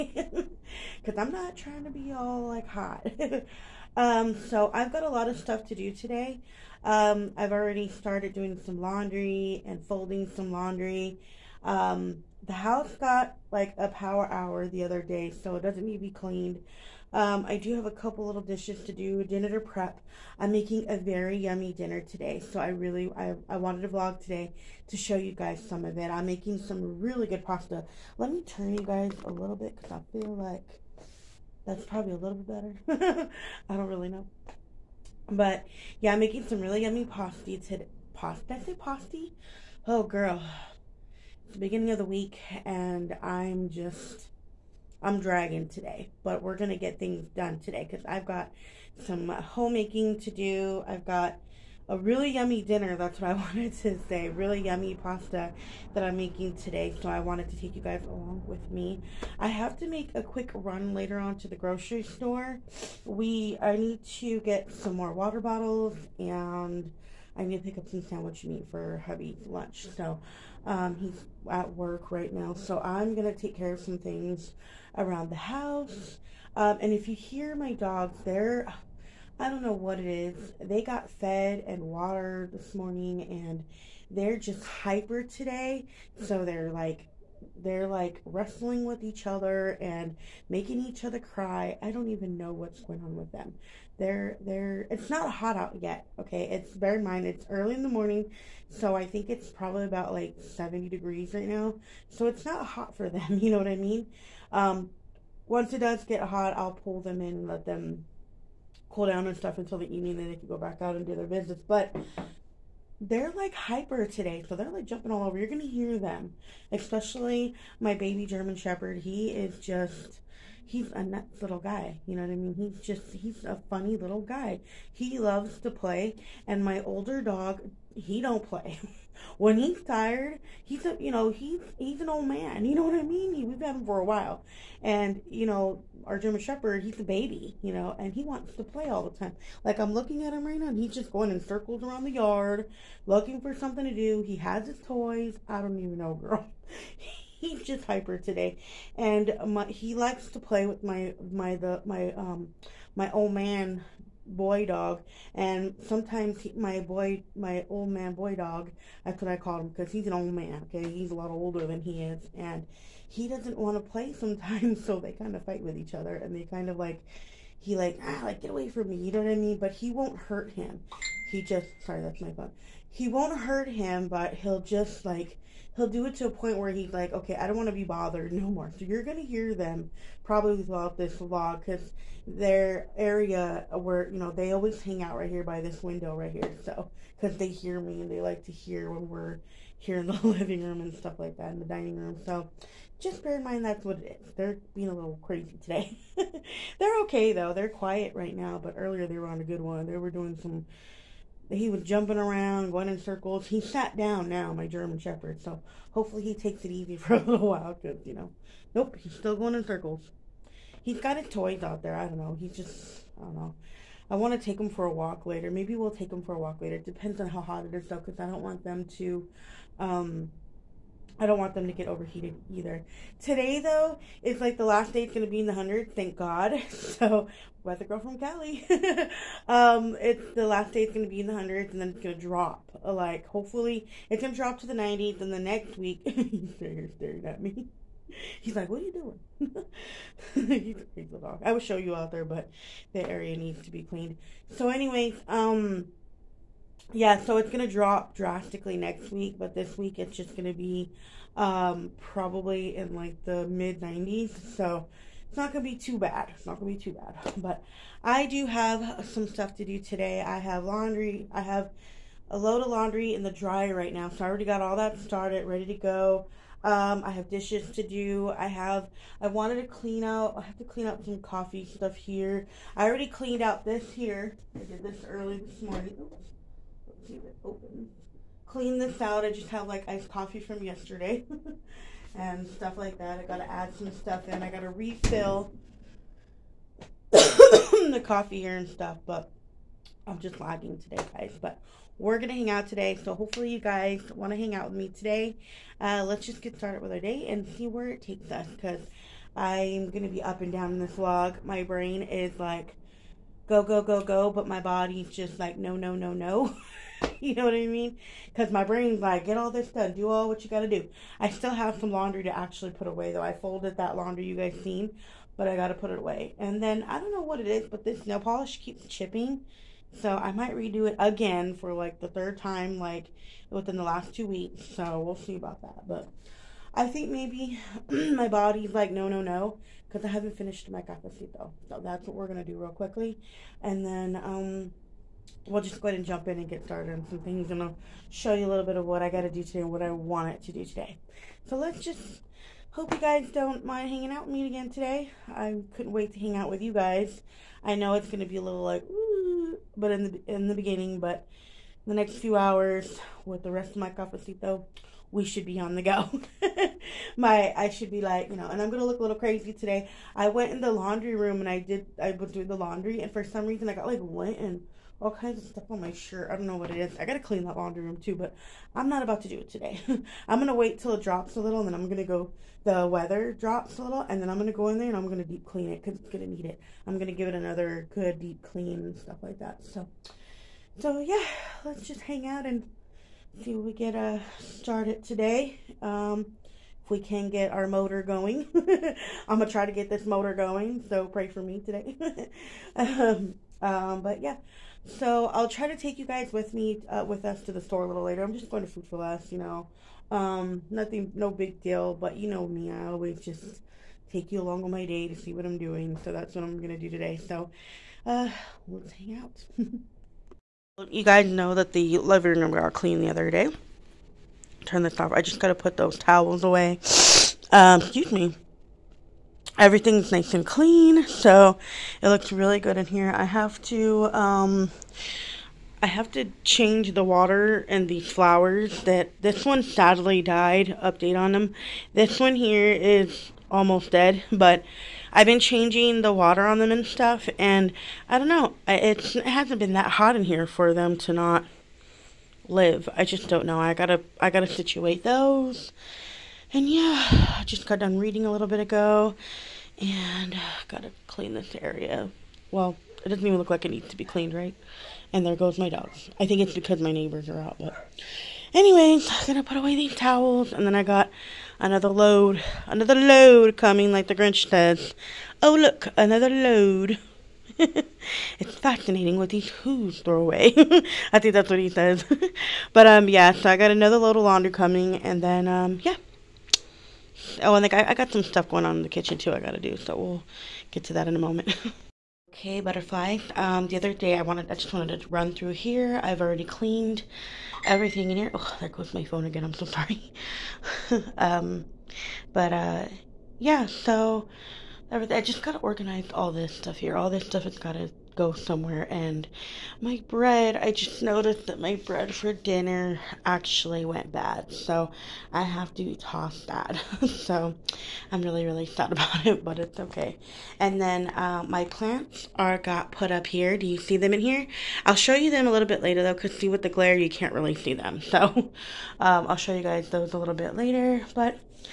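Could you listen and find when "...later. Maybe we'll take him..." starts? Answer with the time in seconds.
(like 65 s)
215 s.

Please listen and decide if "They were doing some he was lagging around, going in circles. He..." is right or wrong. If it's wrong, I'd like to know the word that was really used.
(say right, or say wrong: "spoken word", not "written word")
wrong: "jumping", not "lagging".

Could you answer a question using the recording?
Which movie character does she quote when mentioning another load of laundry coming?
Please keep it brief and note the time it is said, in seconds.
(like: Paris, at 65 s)
The Grinch, at 464 s.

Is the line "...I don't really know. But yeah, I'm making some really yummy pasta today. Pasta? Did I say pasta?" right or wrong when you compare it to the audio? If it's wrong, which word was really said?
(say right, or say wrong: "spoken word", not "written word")
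right.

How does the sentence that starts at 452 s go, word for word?
Well, it doesn't even look like it needs to be cleaned, right?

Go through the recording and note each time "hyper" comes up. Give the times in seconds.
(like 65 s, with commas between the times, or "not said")
84 s, 113 s, 147 s.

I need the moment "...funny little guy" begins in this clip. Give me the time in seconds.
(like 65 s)
123 s.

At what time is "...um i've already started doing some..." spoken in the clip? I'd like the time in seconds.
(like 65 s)
6 s.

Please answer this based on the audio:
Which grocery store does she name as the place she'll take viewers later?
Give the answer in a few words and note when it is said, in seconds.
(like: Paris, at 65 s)
Food 4 Less, at 398 s.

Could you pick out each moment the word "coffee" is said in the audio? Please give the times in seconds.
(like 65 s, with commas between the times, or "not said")
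271 s, 280 s, 288 s.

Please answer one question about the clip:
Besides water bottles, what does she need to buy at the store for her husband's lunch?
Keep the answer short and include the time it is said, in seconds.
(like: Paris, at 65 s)
Sandwich meat, at 68 s.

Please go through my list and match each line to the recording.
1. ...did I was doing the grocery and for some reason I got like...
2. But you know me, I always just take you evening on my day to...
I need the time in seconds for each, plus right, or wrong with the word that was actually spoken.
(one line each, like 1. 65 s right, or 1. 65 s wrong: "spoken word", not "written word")
1. 361 s wrong: "laundry", not "grocery"
2. 401 s wrong: "along", not "evening".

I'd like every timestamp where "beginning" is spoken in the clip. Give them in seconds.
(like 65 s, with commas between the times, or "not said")
41 s, 350 s.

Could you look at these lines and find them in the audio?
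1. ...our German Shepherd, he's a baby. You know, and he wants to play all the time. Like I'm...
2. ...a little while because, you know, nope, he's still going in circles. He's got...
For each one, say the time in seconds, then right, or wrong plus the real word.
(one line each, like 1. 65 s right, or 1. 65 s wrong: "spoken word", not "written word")
1. 136 s right
2. 207 s right.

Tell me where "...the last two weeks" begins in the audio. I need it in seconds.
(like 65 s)
323 s.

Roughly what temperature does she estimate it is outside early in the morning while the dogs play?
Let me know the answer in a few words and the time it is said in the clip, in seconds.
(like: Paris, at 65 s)
70 degrees, at 100 s.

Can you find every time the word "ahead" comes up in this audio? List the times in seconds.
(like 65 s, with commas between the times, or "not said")
335 s.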